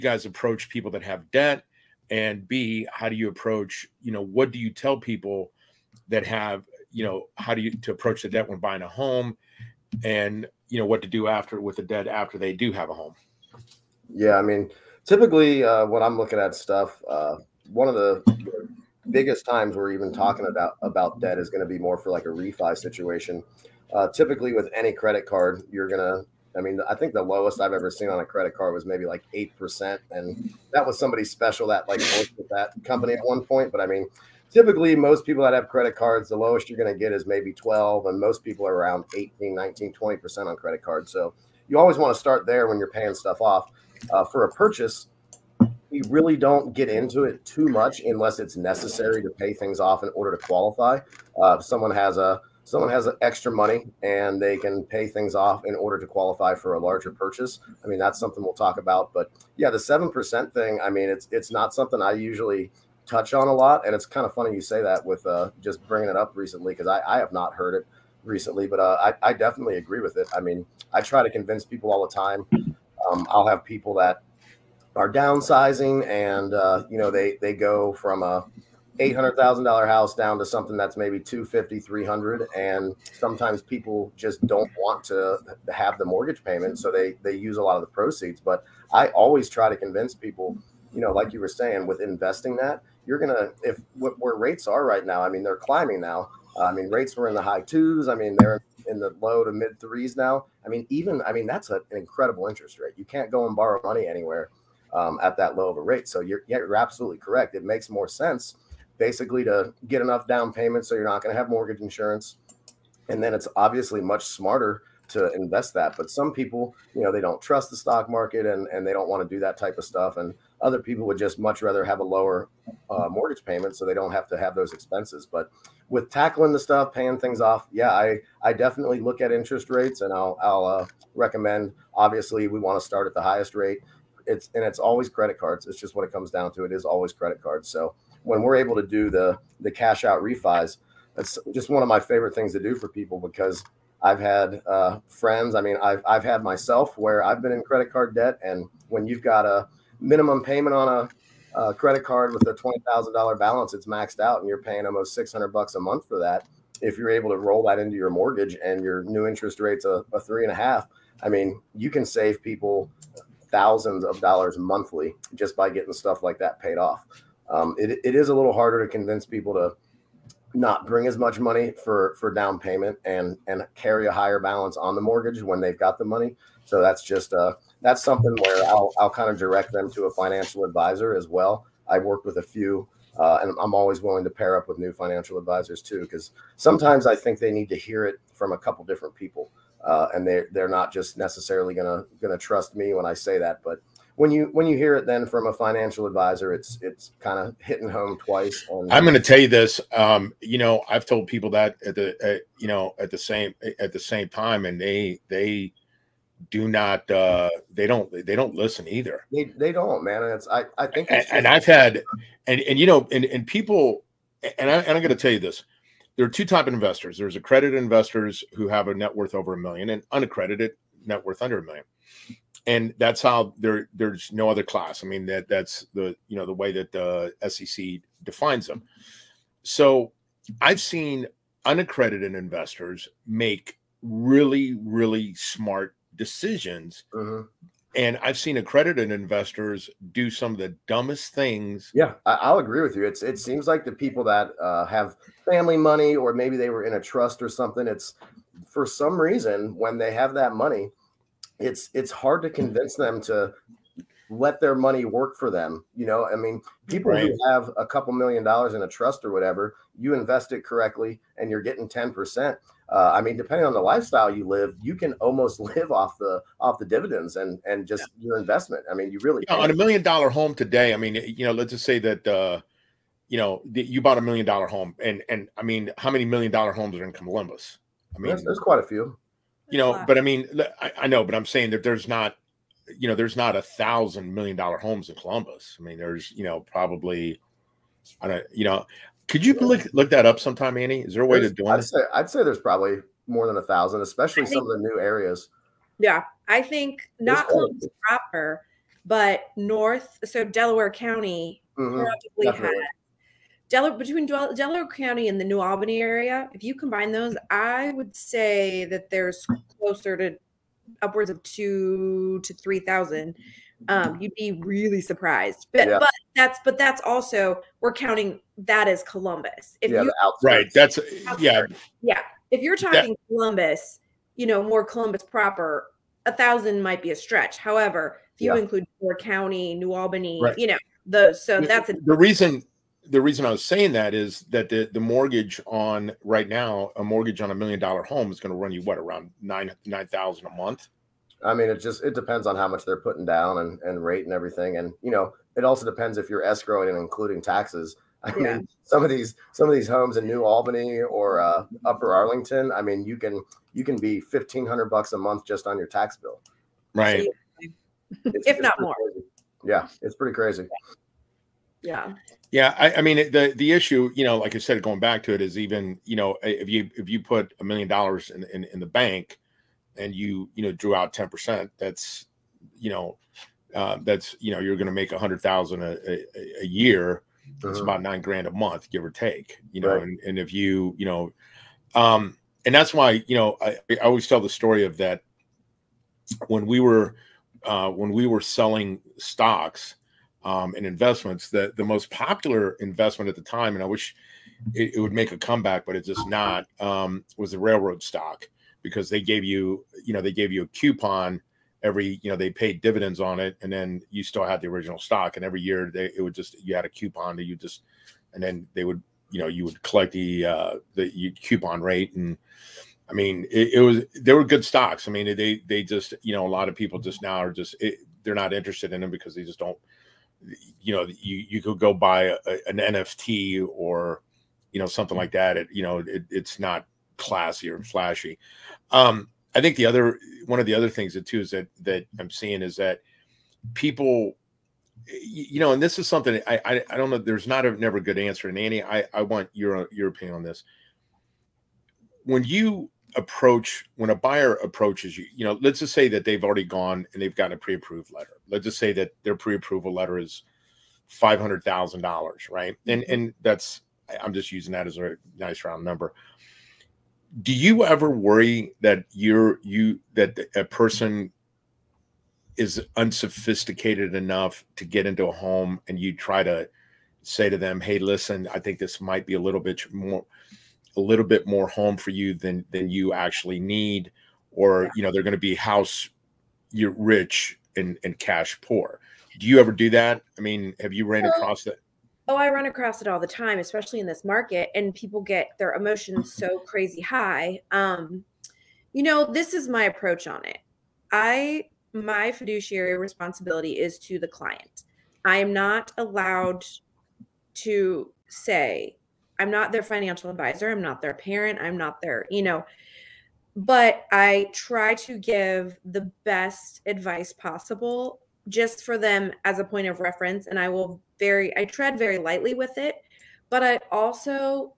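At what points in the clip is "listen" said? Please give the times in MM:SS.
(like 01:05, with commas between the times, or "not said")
03:28, 07:47.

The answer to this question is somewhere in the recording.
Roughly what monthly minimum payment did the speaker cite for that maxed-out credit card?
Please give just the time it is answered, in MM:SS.
02:34.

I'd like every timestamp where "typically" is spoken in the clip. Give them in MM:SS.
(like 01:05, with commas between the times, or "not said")
00:15, 00:24, 00:34.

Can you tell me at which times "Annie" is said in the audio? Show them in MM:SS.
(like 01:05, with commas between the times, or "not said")
04:50, 07:18.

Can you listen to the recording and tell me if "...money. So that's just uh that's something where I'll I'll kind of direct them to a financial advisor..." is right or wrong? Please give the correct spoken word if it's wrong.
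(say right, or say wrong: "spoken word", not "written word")
right.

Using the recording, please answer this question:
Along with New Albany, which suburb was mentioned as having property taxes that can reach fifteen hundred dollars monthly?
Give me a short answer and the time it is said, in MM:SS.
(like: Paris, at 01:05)
Upper Arlington, at 05:51.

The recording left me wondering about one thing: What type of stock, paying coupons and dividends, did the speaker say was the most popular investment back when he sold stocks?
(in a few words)
railroad stock.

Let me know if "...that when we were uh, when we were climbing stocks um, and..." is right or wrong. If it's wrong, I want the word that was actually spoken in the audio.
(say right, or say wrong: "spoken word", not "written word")
wrong: "selling", not "climbing".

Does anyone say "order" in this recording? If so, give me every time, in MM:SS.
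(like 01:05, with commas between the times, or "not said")
00:50, 00:55.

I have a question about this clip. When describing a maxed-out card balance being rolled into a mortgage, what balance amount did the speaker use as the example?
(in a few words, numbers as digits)
$20,000.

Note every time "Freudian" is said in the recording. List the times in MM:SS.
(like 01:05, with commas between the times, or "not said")
not said.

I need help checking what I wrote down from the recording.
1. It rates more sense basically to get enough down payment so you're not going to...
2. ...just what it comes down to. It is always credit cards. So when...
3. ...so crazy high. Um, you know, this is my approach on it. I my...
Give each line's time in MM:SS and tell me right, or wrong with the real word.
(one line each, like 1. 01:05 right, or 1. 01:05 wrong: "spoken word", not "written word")
1. 01:47 wrong: "makes", not "rates"
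2. 02:15 right
3. 08:06 right.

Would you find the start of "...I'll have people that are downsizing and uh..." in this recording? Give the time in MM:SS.
01:13.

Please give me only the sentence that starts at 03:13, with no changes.
But when you when you hear it then from a financial advisor, it's it's kind of hitting home twice.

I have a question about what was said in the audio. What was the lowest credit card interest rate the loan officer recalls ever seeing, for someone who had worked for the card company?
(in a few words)
8 percent.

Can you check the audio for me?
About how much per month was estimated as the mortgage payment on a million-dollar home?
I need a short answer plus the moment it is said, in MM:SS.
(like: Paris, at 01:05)
$9,000, at 05:39.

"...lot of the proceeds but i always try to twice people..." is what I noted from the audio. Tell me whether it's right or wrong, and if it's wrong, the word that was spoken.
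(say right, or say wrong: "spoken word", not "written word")
wrong: "convince", not "twice".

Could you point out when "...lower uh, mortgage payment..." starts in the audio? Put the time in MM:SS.
02:02.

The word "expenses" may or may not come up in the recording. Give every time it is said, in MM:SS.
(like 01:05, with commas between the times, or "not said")
02:04.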